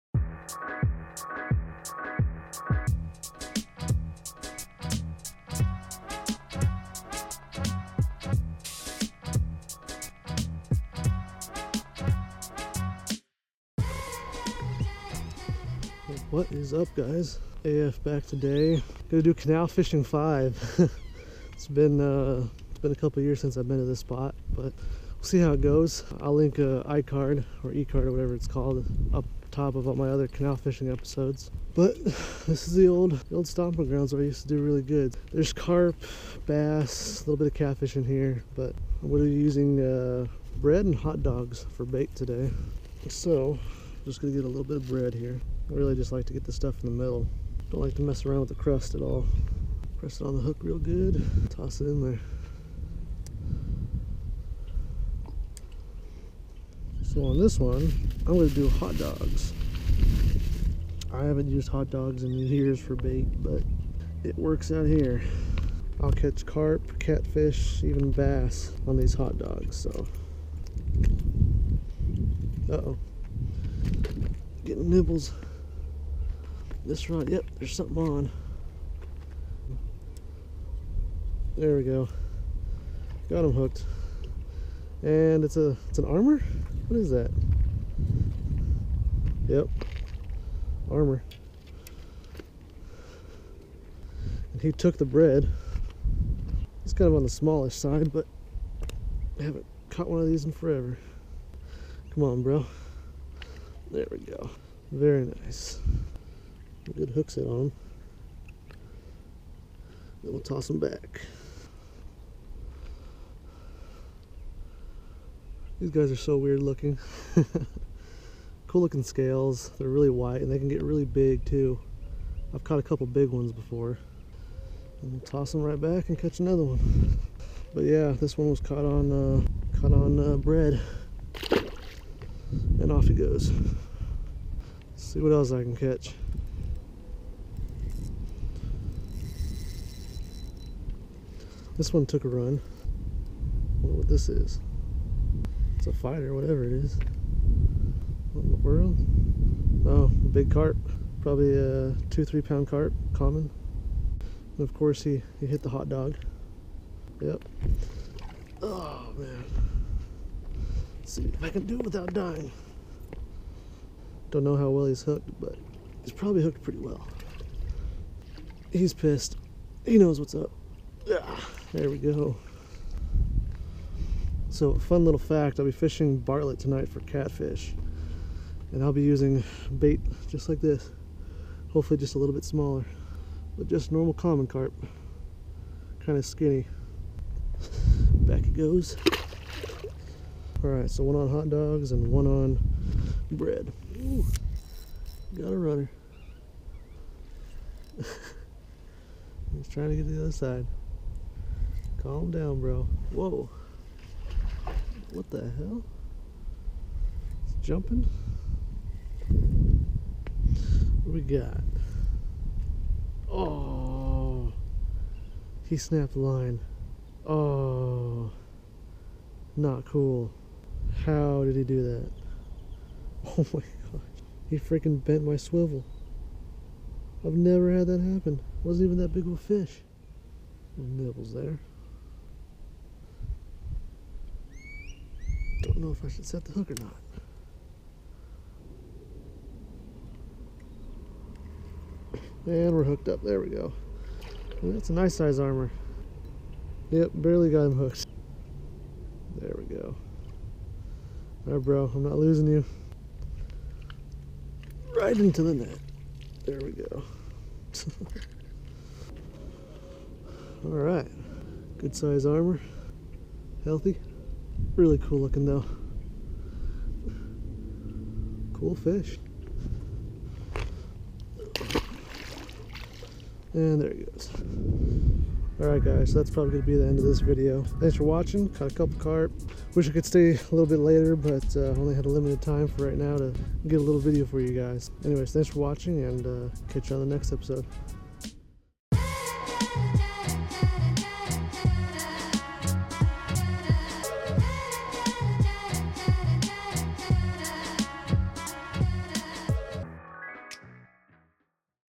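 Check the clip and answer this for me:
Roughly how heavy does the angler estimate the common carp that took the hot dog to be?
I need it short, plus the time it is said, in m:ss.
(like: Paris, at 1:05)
2 to 3 pounds, at 2:32.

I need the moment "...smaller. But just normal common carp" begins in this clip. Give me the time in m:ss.
3:02.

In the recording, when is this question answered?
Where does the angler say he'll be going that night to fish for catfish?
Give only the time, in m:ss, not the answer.
2:56.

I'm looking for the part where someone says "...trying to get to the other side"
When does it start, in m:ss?
3:19.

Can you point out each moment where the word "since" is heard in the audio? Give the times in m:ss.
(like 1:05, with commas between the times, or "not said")
0:23.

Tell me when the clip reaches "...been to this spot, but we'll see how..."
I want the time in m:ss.
0:23.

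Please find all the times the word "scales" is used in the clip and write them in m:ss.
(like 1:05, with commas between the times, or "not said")
1:59.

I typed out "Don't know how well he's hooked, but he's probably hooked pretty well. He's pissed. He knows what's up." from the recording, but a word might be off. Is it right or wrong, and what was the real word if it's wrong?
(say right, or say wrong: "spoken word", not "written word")
right.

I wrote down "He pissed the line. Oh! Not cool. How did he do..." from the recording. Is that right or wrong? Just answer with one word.
wrong.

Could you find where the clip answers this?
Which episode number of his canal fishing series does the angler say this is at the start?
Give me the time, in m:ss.
0:20.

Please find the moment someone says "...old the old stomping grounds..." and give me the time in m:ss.
0:32.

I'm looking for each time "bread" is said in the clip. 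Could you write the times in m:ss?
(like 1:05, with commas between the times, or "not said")
0:40, 0:44, 1:35, 2:10, 3:13.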